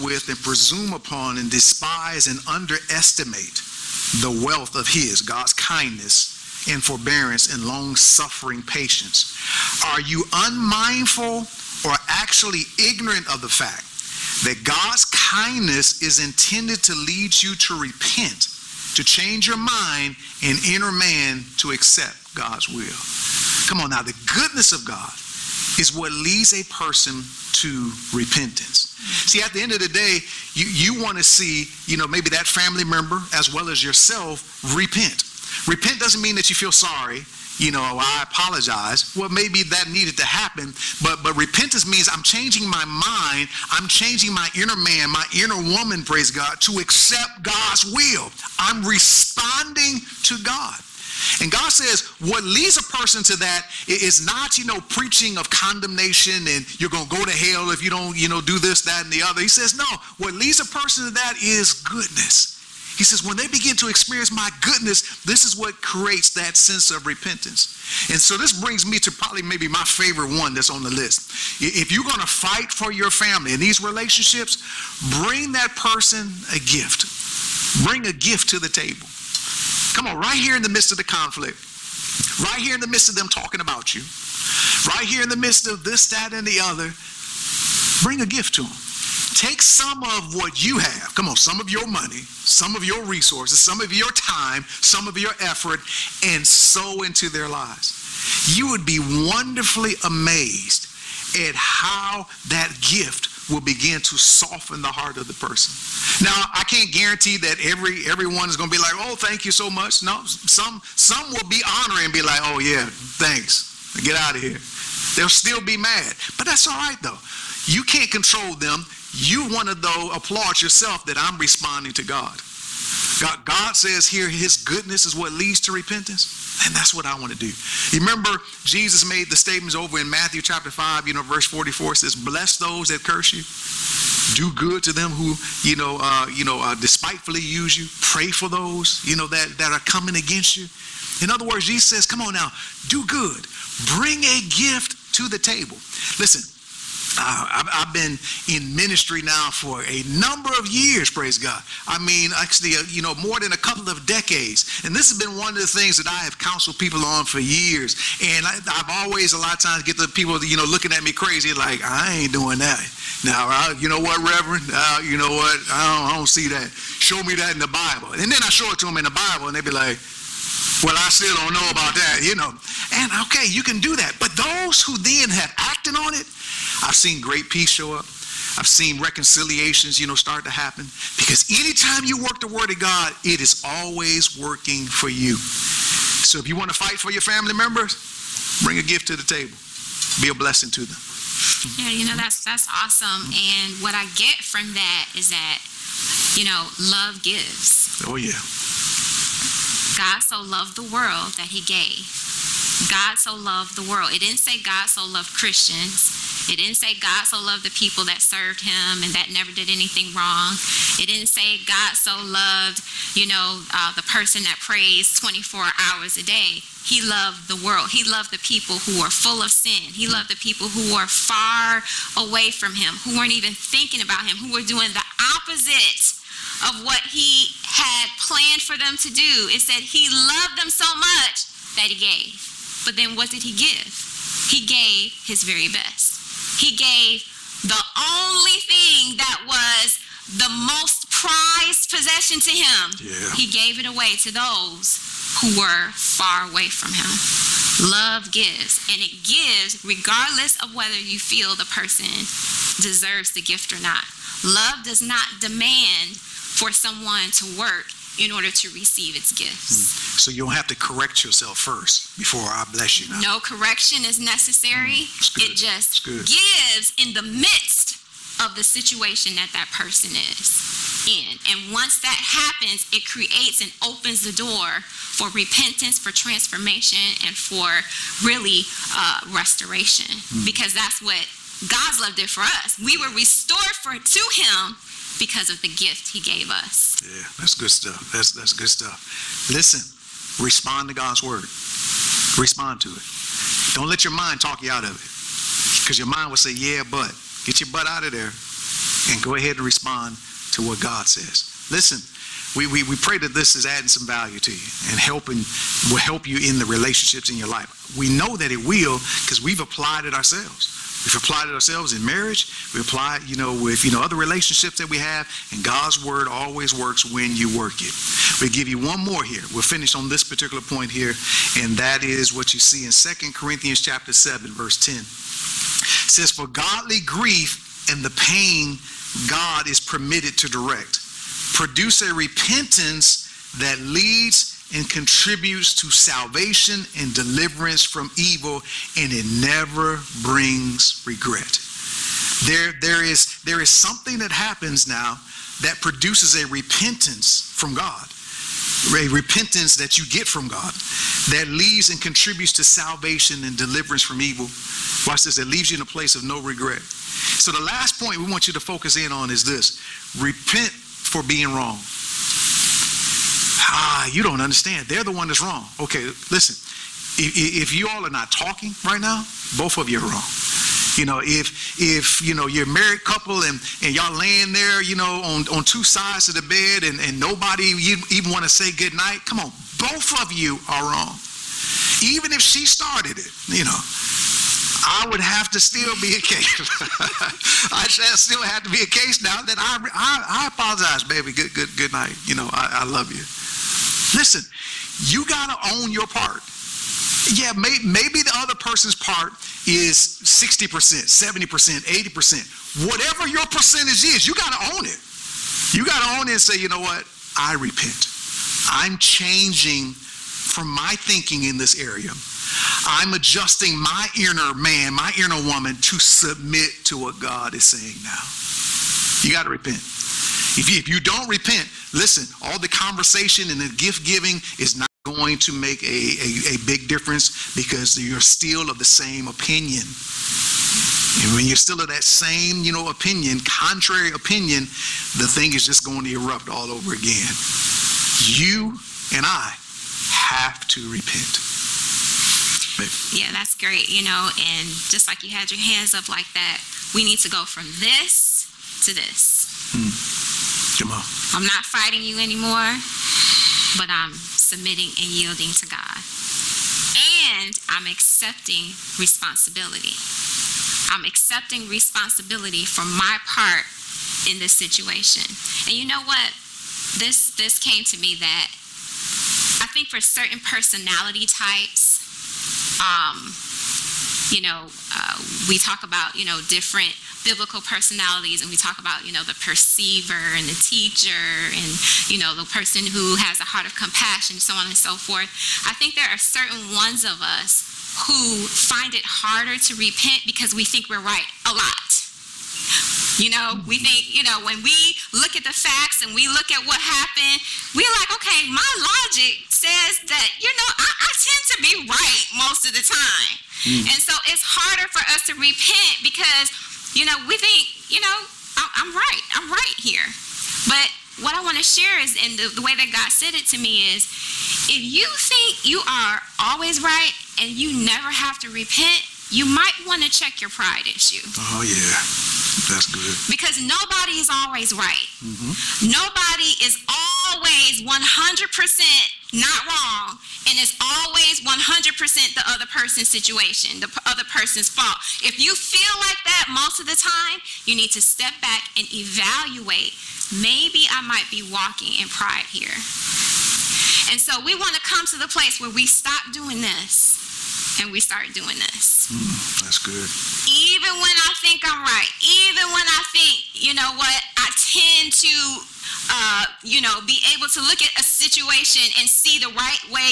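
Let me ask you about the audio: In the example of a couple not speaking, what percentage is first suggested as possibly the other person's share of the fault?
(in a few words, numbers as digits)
60%.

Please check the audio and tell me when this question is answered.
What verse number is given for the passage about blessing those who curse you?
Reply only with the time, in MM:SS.
02:11.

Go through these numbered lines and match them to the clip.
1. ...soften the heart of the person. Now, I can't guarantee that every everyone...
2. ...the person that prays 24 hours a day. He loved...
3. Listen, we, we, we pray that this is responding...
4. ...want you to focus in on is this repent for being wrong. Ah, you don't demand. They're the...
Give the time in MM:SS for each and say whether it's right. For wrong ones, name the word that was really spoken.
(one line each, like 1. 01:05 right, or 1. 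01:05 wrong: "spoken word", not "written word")
1. 01:44 right
2. 03:33 right
3. 05:01 wrong: "adding", not "responding"
4. 05:58 wrong: "understand", not "demand".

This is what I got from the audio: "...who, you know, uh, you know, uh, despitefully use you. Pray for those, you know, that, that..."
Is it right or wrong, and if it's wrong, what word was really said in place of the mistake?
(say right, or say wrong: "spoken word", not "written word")
right.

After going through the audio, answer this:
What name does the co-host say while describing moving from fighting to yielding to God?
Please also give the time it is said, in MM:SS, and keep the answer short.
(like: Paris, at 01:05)
Jamal, at 07:30.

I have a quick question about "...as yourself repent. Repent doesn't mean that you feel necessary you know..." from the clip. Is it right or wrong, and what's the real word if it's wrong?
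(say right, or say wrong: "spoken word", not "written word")
wrong: "sorry", not "necessary".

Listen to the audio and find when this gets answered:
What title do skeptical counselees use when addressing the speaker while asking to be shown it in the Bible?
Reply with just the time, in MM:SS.
02:44.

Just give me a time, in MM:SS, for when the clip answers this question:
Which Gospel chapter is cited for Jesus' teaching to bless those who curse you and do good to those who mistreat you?
02:10.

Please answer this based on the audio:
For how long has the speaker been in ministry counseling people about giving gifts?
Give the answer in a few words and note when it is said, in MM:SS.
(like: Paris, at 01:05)
More than a couple of decades, at 02:33.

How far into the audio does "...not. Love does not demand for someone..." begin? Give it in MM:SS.
04:13.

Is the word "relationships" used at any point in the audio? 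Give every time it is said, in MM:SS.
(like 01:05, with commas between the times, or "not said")
01:13, 05:06, 05:14.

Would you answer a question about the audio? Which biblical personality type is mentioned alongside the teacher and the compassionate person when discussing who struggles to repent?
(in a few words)
The perceiver.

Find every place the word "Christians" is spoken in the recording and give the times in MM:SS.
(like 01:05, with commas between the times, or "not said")
03:25.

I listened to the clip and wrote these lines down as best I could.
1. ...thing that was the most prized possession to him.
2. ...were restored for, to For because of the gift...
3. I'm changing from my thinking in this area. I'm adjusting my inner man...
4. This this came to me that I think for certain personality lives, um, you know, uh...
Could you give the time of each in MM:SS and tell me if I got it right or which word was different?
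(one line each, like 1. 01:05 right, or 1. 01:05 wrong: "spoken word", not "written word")
1. 03:58 right
2. 04:43 wrong: "Him", not "For"
3. 06:48 right
4. 07:46 wrong: "types", not "lives".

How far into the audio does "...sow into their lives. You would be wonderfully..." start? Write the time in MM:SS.
01:36.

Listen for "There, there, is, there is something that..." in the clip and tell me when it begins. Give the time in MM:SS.
05:42.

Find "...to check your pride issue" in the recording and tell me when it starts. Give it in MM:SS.
08:40.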